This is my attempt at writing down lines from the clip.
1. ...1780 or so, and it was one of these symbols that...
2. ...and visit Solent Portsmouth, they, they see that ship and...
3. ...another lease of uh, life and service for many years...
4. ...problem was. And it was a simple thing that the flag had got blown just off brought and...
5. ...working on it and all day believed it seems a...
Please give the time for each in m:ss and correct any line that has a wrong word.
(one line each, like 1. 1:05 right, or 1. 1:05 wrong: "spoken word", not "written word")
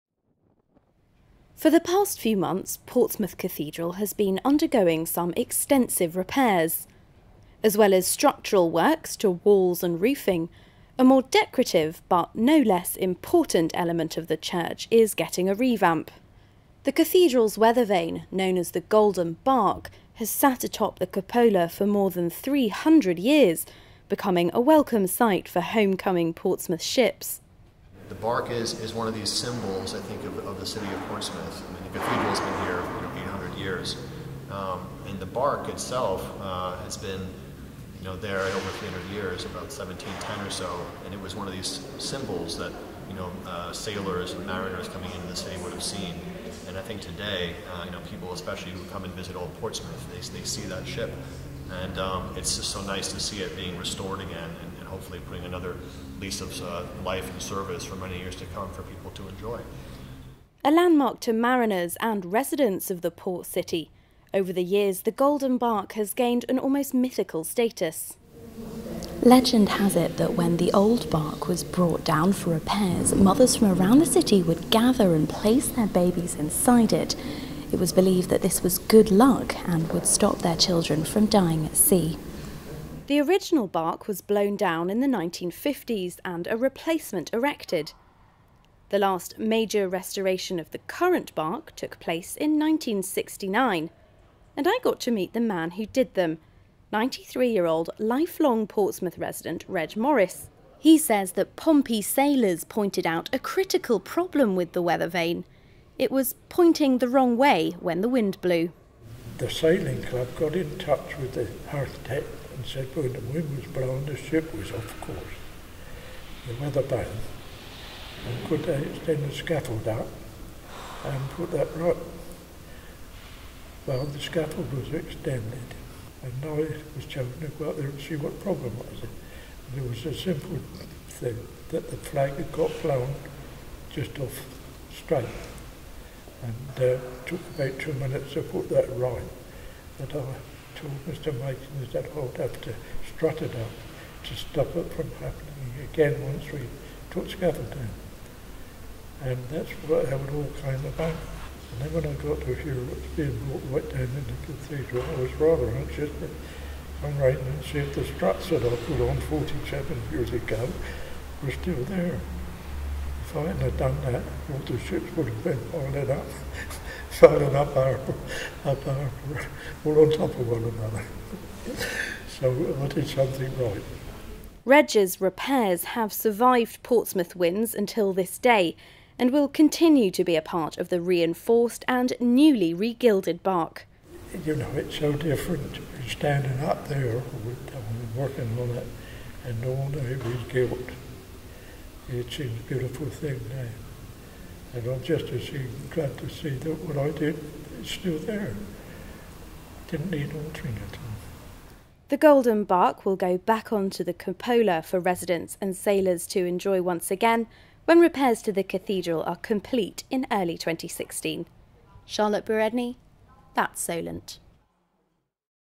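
1. 0:39 wrong: "1710", not "1780"
2. 0:49 wrong: "Old", not "Solent"
3. 0:55 right
4. 2:08 wrong: "straight", not "brought"
5. 3:08 wrong: "regilled", not "believed".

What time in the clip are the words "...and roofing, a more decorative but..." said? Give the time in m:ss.
0:09.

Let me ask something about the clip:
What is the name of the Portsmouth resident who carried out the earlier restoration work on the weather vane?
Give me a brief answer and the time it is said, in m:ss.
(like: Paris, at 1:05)
Reg Morris, at 1:39.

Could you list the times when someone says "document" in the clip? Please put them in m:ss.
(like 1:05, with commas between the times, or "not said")
not said.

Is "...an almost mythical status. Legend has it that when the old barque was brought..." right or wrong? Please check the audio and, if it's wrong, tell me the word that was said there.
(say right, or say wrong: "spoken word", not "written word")
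right.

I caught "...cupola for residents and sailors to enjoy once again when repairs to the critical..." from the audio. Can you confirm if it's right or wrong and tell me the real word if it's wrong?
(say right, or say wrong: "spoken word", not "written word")
wrong: "cathedral", not "critical".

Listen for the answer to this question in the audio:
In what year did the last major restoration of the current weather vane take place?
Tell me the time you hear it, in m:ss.
1:32.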